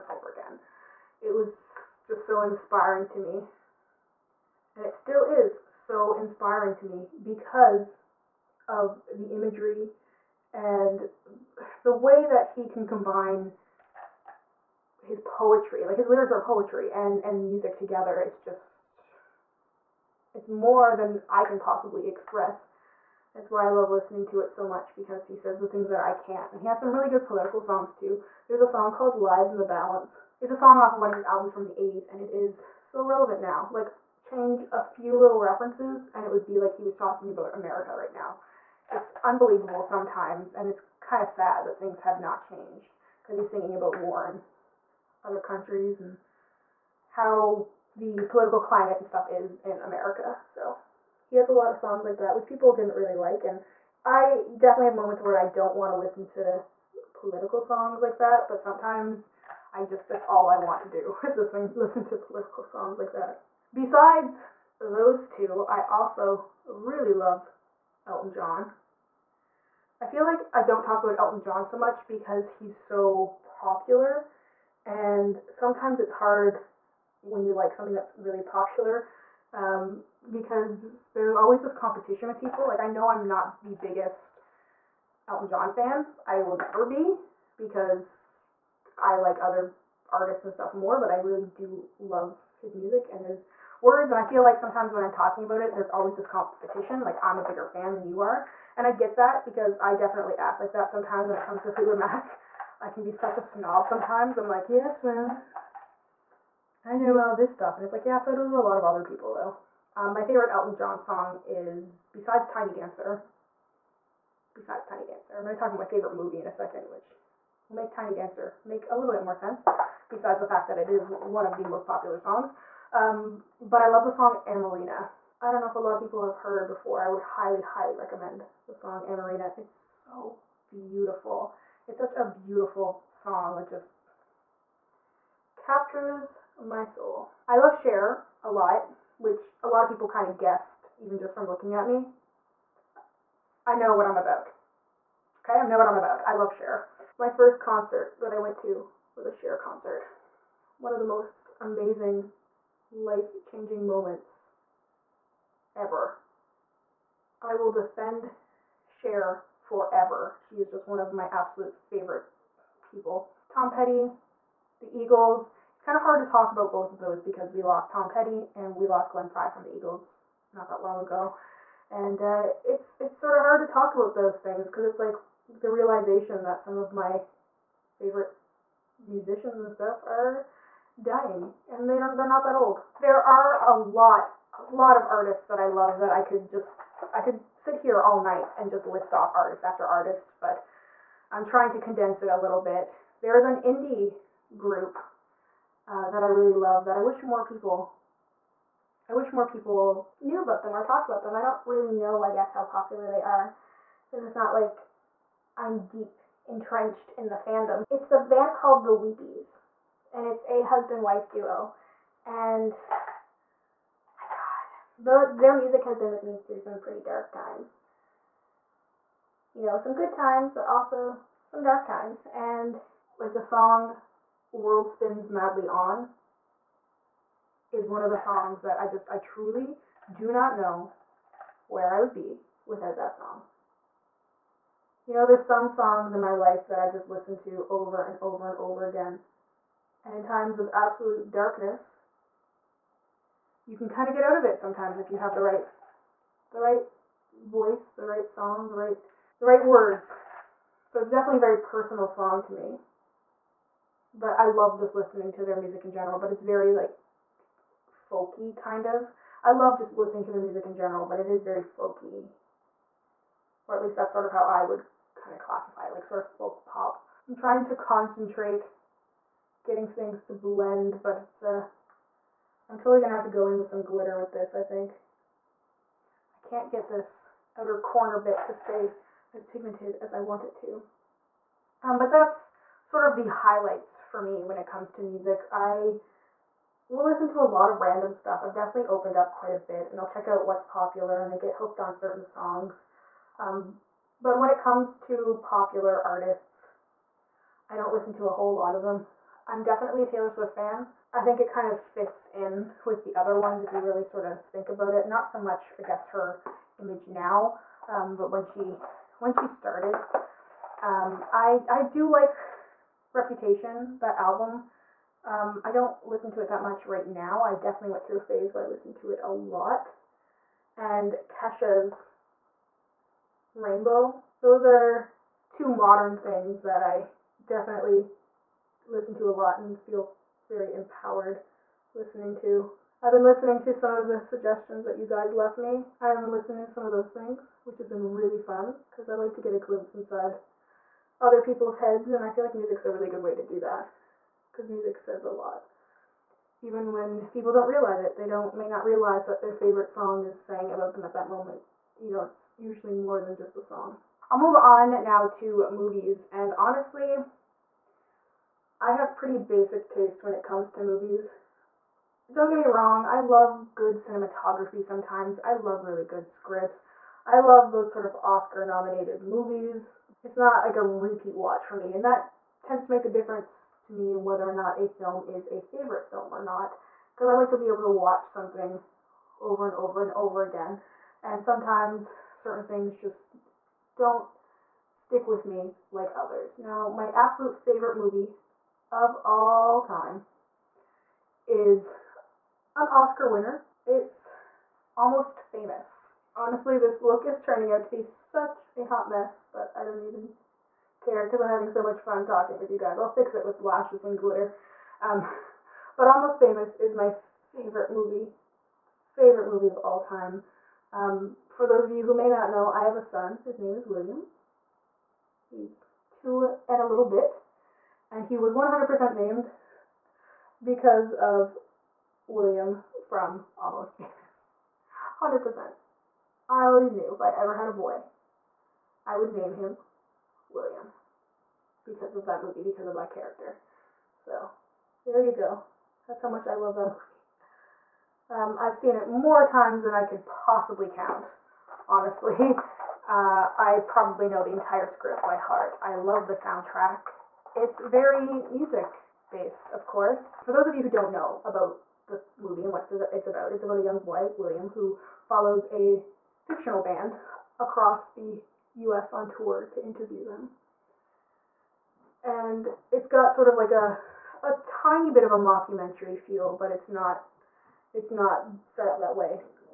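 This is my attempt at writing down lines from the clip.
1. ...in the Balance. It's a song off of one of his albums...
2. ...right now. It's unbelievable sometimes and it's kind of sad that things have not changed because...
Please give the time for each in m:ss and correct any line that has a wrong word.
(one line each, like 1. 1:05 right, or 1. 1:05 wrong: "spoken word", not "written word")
1. 0:29 right
2. 0:37 right.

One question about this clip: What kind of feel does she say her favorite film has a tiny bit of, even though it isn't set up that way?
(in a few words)
mockumentary.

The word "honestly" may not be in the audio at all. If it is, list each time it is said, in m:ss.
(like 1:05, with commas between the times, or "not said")
5:56, 6:36, 7:21.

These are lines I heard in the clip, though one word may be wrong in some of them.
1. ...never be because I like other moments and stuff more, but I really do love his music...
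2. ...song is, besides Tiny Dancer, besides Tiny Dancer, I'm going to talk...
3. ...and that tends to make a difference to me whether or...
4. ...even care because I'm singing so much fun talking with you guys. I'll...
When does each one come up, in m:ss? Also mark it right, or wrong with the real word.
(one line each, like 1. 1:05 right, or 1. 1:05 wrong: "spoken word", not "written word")
1. 1:26 wrong: "artists", not "moments"
2. 1:51 right
3. 6:11 right
4. 6:40 wrong: "having", not "singing".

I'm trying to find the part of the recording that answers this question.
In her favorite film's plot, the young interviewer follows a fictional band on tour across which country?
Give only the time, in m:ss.
7:38.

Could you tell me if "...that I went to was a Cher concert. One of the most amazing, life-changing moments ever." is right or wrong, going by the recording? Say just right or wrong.
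right.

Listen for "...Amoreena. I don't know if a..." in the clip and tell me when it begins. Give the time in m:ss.
2:04.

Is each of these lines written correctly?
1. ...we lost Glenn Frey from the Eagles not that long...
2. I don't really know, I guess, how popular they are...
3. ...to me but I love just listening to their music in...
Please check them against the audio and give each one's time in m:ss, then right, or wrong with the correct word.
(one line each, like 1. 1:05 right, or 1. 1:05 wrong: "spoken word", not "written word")
1. 2:48 right
2. 3:21 right
3. 4:12 right.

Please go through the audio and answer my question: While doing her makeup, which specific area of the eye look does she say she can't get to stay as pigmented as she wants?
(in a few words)
outer corner.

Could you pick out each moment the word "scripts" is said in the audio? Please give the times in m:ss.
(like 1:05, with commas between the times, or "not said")
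6:06, 7:24.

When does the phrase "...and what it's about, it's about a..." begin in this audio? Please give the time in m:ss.
7:32.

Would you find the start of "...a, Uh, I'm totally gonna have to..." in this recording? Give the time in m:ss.
4:31.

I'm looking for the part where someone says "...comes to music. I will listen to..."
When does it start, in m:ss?
4:44.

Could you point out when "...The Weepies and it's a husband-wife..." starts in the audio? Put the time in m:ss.
3:28.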